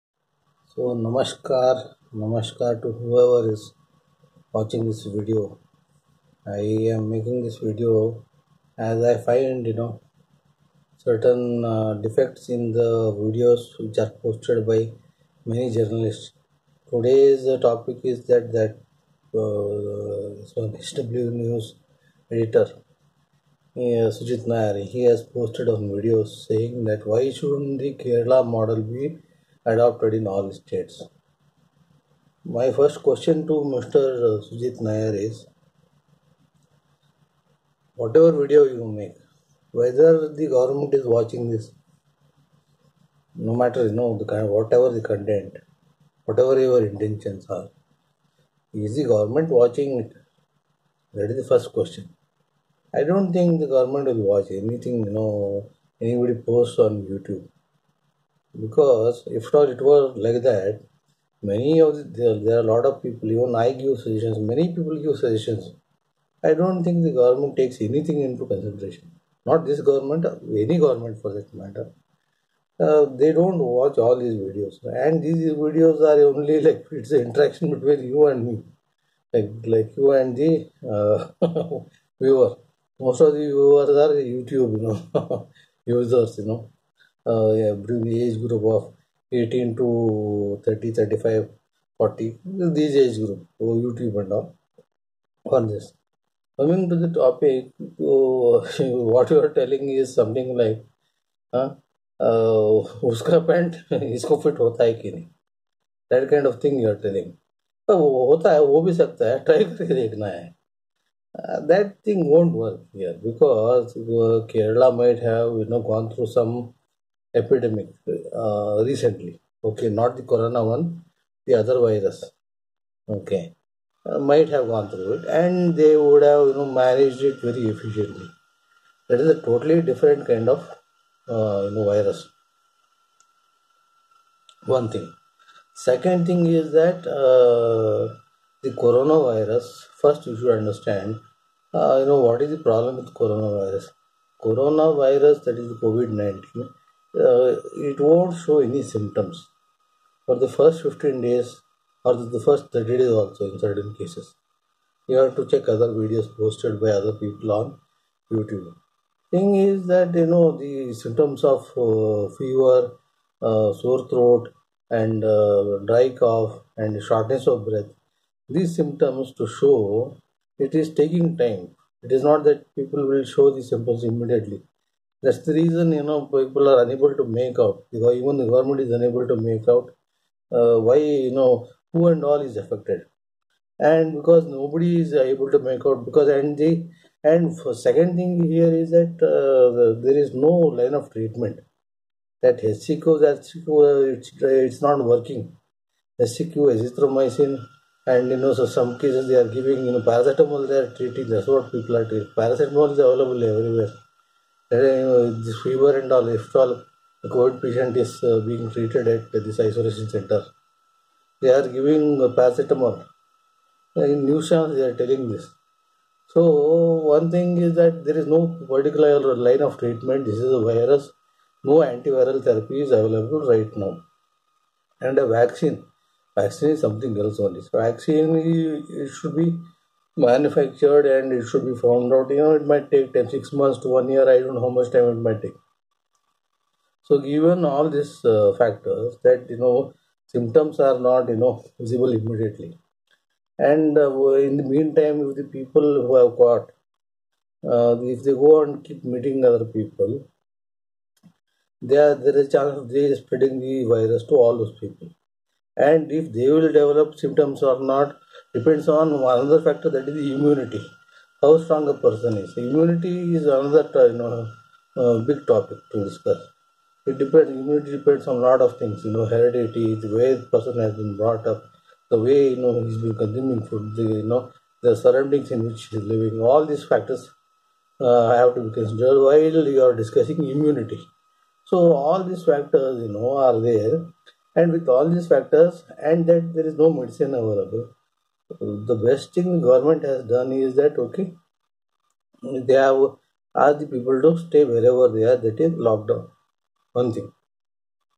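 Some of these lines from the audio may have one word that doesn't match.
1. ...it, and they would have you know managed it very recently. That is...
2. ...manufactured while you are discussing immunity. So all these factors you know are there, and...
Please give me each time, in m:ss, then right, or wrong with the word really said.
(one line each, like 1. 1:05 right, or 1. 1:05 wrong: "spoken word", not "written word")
1. 2:05 wrong: "efficiently", not "recently"
2. 4:38 wrong: "considered", not "manufactured".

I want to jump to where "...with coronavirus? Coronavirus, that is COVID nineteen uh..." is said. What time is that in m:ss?
2:22.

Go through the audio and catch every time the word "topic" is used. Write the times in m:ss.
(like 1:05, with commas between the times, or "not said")
0:17, 1:37, 4:25.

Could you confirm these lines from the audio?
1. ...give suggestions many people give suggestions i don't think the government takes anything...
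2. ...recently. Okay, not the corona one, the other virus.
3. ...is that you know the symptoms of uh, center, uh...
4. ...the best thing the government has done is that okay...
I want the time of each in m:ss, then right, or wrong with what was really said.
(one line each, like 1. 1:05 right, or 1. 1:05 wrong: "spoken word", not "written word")
1. 1:03 right
2. 1:58 right
3. 2:39 wrong: "fever", not "center"
4. 4:48 right.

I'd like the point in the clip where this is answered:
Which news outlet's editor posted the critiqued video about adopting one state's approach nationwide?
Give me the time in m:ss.
0:20.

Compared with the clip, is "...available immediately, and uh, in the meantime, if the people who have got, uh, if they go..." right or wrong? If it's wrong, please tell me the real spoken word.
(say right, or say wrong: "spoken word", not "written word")
wrong: "visible", not "available".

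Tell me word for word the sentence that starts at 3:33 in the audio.
Uh, in news channels, they are telling this.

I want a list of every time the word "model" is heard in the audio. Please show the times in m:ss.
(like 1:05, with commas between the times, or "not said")
0:28.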